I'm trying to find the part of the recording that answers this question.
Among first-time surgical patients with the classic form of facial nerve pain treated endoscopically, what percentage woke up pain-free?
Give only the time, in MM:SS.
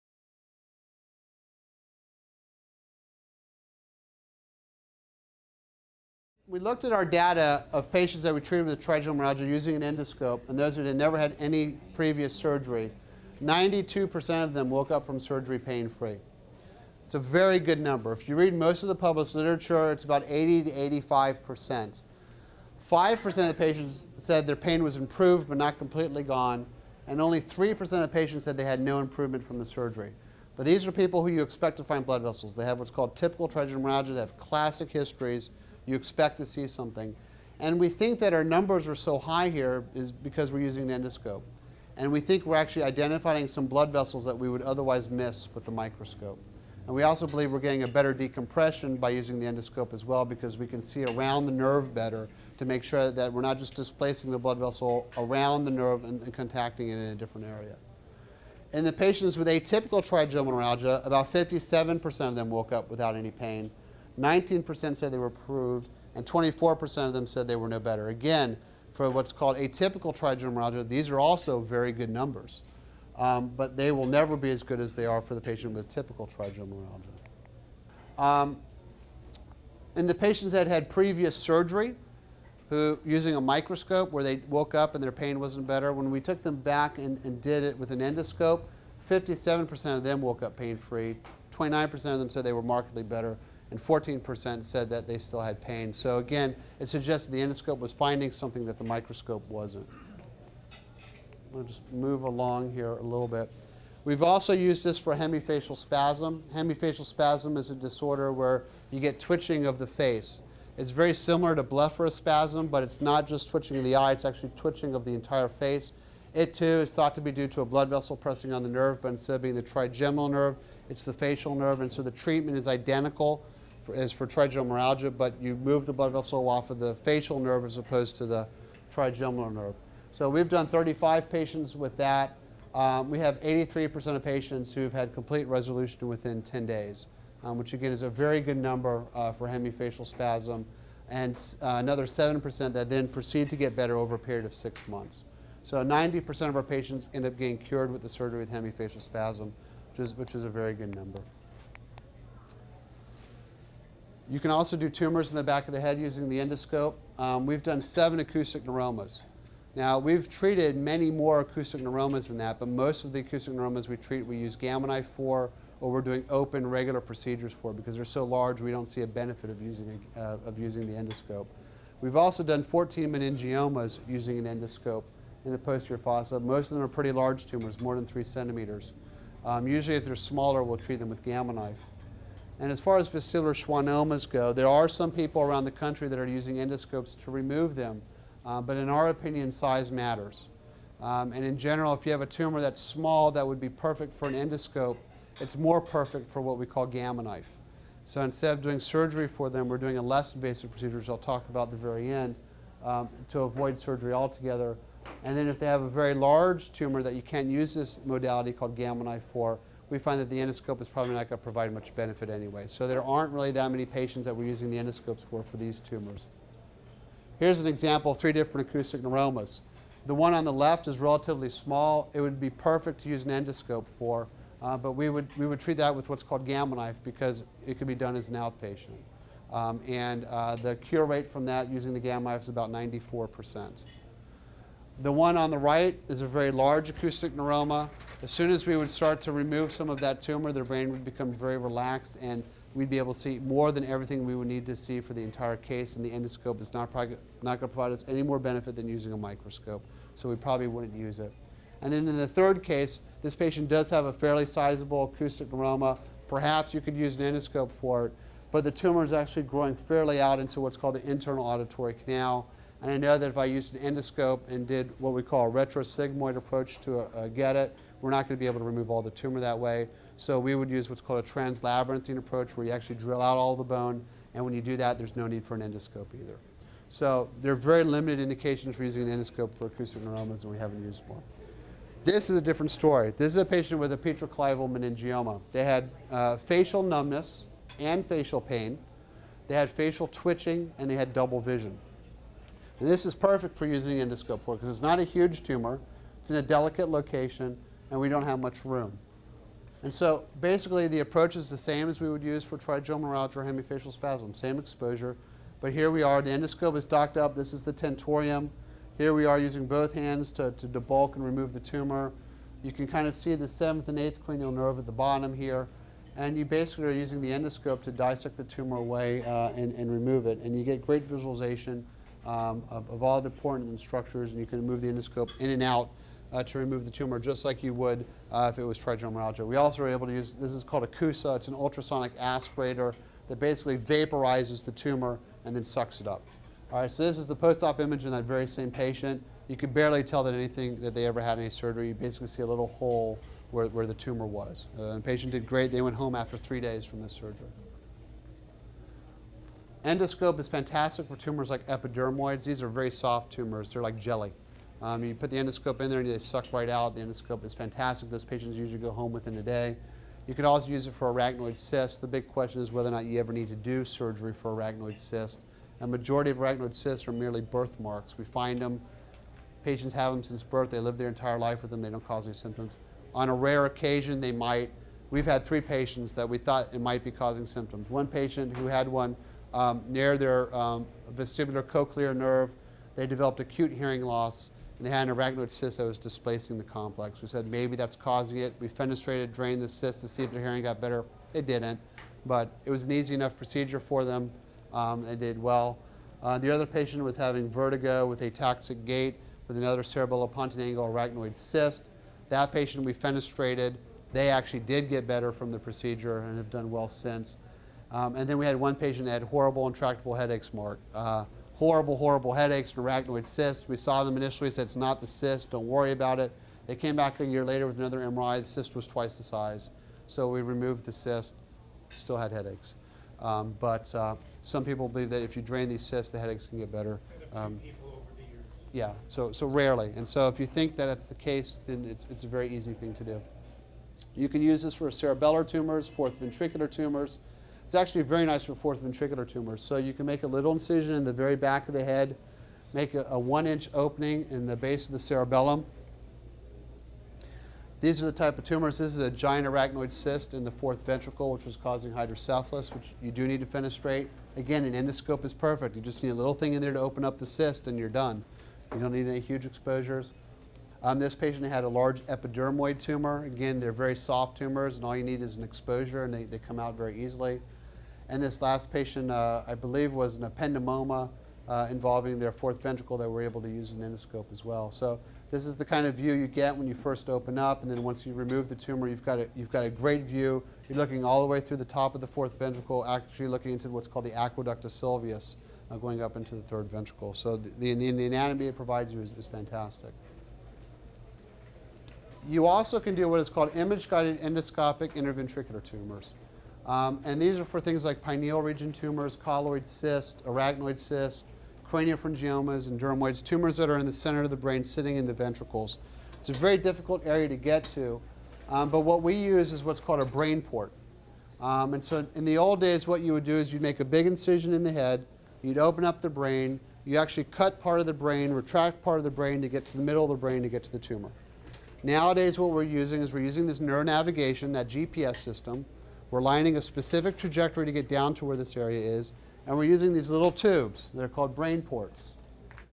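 00:13.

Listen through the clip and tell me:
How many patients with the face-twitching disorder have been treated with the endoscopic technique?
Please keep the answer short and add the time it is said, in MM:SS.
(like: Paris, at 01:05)
35, at 02:10.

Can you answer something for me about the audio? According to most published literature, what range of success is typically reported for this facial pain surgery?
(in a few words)
80 to 85%.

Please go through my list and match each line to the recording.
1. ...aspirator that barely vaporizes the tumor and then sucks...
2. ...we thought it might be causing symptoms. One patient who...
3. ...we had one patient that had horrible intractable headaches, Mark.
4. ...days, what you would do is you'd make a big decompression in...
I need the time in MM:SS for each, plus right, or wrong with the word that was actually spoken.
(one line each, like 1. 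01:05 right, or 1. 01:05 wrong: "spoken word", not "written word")
1. 05:32 wrong: "basically", not "barely"
2. 06:16 right
3. 06:48 right
4. 08:32 wrong: "incision", not "decompression".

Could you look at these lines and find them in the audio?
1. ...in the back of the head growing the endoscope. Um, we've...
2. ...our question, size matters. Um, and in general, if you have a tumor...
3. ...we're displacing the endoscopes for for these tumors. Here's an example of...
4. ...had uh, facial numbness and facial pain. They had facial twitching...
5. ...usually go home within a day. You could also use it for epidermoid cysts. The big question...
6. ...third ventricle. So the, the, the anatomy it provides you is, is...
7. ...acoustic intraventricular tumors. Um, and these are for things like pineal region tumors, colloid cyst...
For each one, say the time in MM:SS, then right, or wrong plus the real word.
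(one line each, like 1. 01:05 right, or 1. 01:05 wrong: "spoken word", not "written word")
1. 02:35 wrong: "using", not "growing"
2. 03:08 wrong: "opinion", not "question"
3. 03:34 wrong: "using", not "displacing"
4. 04:45 right
5. 05:58 wrong: "arachnoid", not "epidermoid"
6. 08:06 right
7. 08:14 wrong: "endoscopic", not "acoustic".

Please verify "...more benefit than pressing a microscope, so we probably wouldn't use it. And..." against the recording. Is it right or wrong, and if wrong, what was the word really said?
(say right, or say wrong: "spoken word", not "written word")
wrong: "using", not "pressing".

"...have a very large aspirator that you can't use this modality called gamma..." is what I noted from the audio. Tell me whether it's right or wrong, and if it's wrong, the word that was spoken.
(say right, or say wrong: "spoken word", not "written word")
wrong: "tumor", not "aspirator".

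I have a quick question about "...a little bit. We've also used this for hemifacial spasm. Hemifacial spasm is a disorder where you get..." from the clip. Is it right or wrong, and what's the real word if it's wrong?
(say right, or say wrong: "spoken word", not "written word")
right.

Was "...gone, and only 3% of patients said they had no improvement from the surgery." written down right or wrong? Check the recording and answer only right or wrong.
right.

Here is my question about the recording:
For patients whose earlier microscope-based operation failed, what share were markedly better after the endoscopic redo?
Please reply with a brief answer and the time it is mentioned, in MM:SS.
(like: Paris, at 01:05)
29%, at 01:31.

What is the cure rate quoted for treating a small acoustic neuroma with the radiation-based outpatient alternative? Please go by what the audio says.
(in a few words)
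94 percent.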